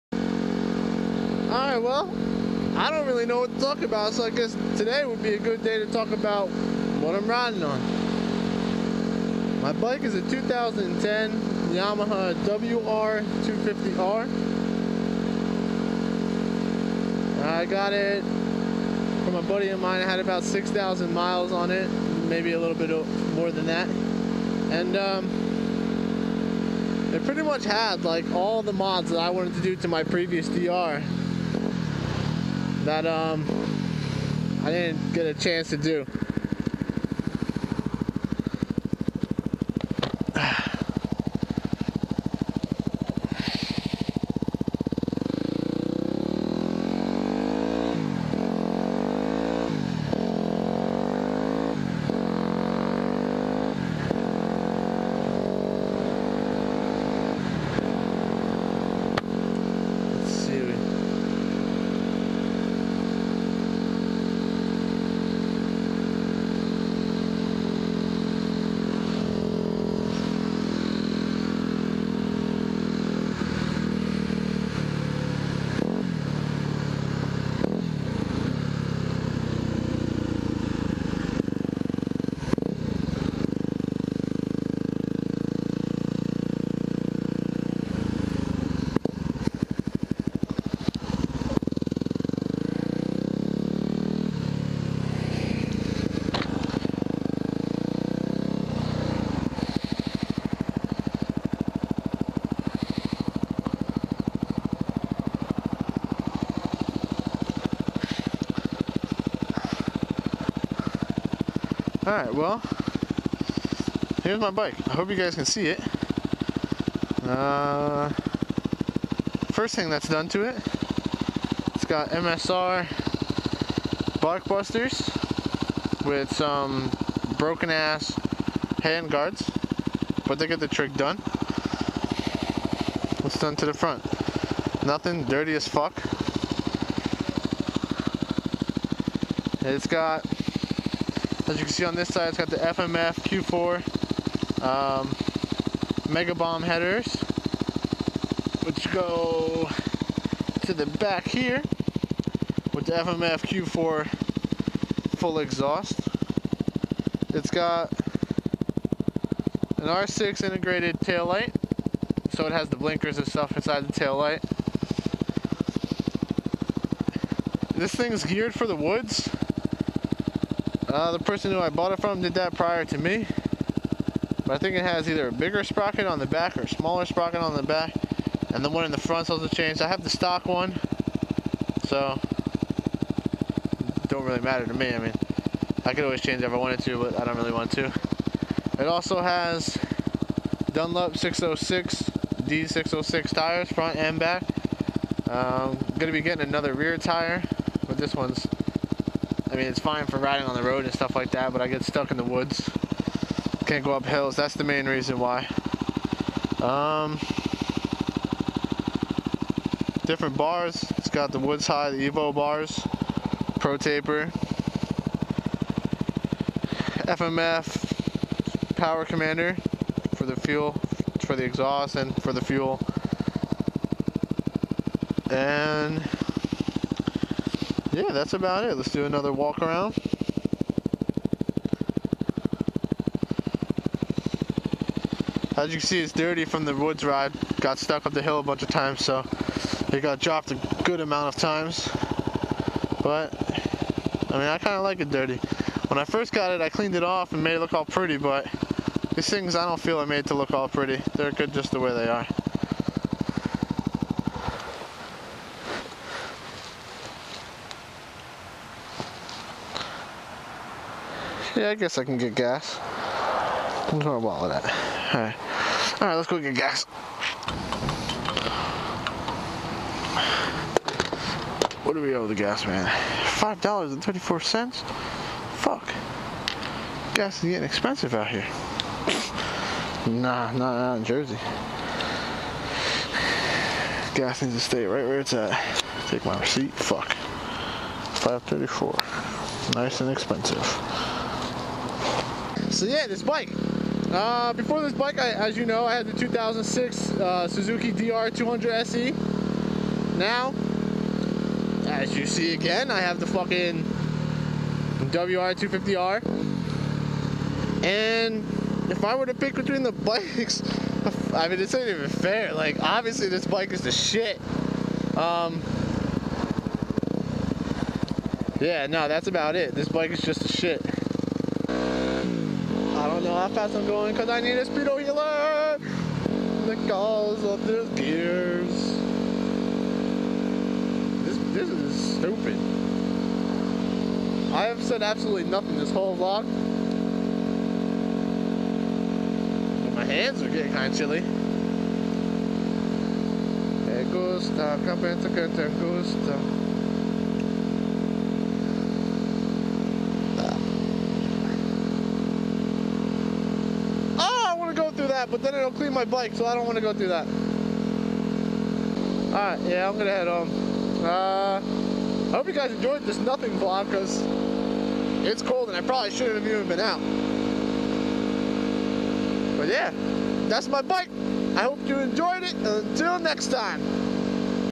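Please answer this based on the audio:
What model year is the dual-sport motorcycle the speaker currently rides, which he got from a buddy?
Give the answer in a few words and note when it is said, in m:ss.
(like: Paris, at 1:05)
2010, at 0:10.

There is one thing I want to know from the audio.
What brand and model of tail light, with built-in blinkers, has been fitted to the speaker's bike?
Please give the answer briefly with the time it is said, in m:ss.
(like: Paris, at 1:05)
R6, at 2:39.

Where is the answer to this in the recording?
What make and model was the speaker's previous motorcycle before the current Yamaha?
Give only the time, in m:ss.
4:57.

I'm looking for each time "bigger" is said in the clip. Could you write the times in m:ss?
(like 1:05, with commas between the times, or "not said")
2:55.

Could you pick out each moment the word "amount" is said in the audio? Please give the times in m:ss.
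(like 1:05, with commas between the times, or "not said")
4:01.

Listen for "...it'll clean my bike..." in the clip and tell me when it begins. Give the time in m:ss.
5:55.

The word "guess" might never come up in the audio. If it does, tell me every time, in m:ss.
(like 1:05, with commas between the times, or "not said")
0:04, 4:21.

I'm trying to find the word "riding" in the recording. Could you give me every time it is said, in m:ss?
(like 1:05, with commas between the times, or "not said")
0:07, 3:20.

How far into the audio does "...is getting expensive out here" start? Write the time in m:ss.
4:37.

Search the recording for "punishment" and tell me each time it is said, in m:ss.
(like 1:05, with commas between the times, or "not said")
not said.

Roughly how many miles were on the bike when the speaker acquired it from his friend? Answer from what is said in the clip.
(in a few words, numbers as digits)
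6,000.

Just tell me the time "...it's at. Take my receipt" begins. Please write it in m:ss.
4:45.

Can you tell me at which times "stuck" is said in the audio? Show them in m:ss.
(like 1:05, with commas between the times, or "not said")
3:21, 3:57.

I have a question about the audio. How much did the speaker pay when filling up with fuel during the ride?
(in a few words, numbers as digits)
$5.34.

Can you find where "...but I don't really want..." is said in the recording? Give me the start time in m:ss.
3:07.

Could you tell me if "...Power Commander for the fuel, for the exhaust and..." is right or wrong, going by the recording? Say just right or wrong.
right.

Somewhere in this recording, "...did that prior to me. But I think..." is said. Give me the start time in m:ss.
2:52.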